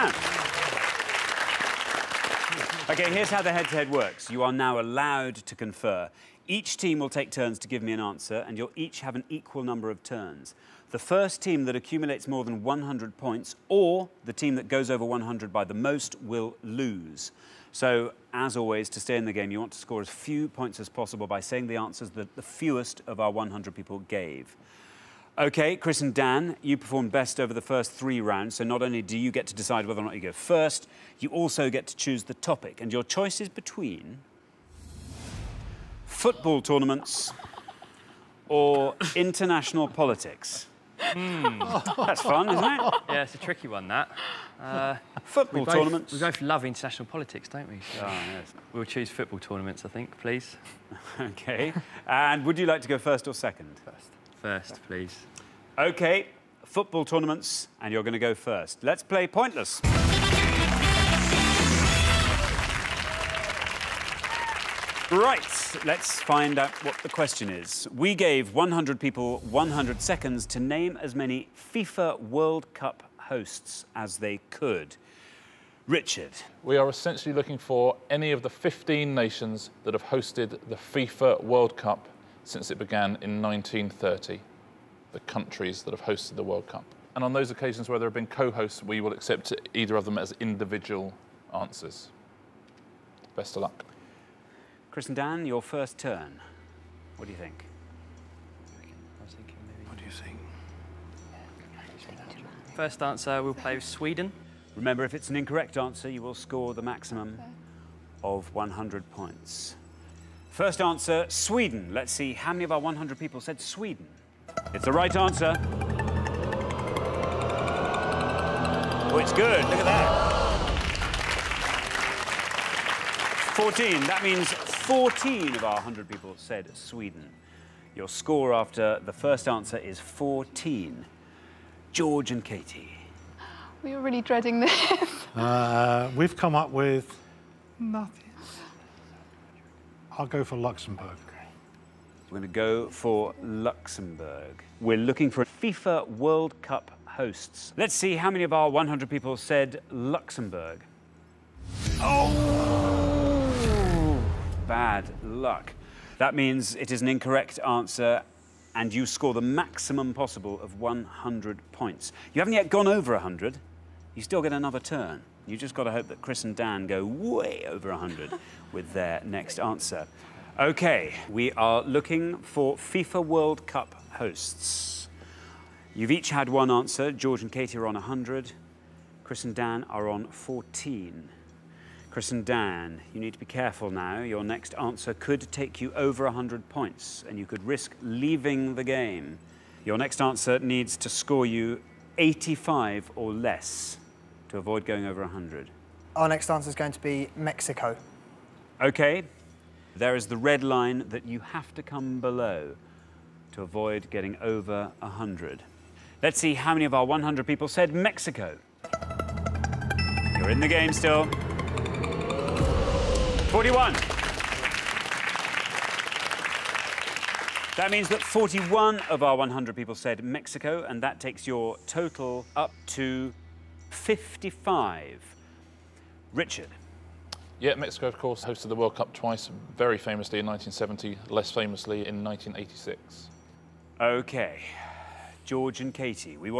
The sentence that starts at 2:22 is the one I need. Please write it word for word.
We're going to go for Luxembourg.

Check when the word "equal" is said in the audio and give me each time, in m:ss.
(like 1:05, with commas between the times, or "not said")
0:09.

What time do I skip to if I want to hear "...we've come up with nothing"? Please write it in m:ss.
2:16.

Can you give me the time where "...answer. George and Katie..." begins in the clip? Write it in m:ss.
2:56.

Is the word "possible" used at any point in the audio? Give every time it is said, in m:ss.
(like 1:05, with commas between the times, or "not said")
0:20, 2:40.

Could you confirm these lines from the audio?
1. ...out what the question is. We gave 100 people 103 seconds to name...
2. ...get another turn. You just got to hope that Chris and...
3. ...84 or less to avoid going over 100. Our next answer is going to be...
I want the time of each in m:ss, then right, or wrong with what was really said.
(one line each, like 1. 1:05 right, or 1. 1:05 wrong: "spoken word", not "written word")
1. 1:06 wrong: "100", not "103"
2. 2:44 right
3. 3:12 wrong: "85", not "84".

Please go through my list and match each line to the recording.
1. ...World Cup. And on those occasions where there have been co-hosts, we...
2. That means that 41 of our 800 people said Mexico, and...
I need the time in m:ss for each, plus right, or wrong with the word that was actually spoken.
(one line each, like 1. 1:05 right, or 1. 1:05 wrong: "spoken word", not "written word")
1. 1:26 right
2. 3:37 wrong: "100", not "800".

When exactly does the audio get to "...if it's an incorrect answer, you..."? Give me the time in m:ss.
1:45.